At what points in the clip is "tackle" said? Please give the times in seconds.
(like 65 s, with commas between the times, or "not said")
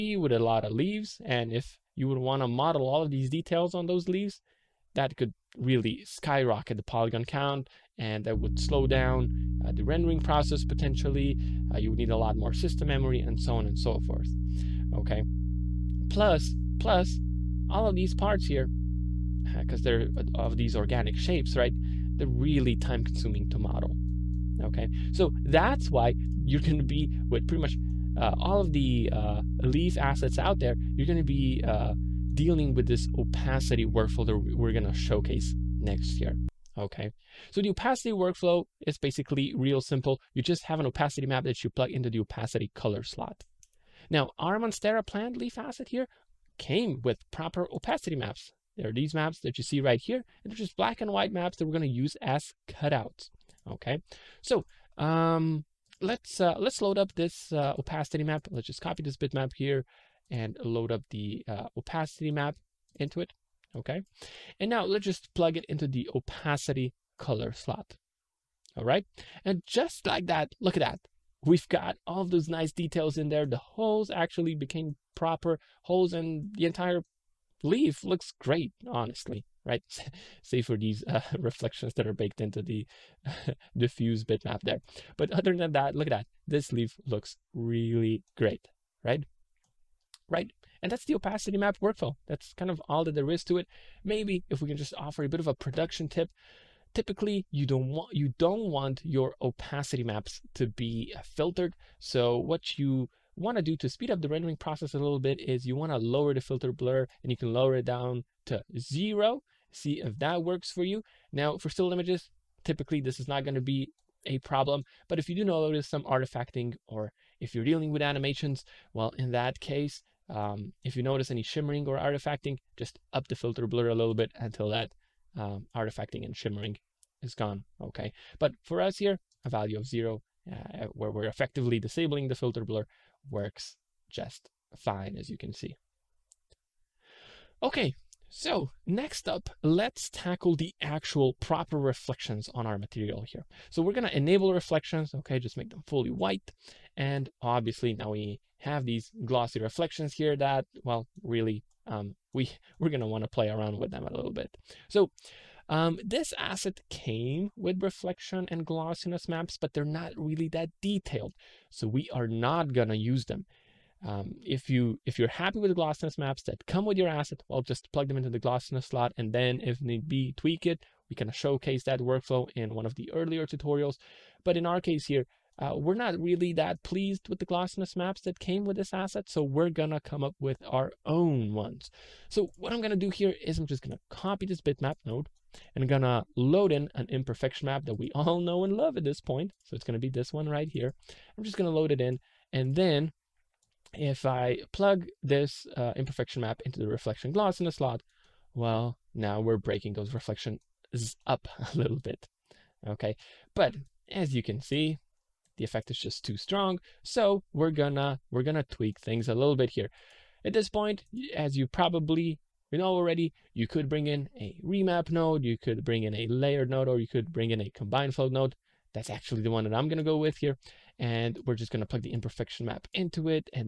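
140 s.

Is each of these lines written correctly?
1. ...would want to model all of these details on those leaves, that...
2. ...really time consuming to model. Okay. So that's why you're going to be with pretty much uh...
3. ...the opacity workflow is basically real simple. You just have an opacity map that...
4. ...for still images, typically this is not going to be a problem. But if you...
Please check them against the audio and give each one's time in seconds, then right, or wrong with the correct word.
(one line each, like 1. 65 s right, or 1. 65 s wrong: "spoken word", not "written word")
1. 2 s right
2. 22 s right
3. 37 s right
4. 111 s right.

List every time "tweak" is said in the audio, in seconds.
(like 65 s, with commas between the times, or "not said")
170 s, 208 s.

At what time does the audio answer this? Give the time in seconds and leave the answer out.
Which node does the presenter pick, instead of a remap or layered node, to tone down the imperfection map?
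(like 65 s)
217 s.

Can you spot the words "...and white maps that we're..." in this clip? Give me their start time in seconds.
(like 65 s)
50 s.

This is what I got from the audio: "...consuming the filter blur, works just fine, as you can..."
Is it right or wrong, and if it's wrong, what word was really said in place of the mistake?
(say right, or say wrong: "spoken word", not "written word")
wrong: "disabling", not "consuming".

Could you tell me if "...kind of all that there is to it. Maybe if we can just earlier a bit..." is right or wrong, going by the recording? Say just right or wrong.
wrong.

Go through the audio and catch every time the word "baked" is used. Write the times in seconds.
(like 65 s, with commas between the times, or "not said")
82 s.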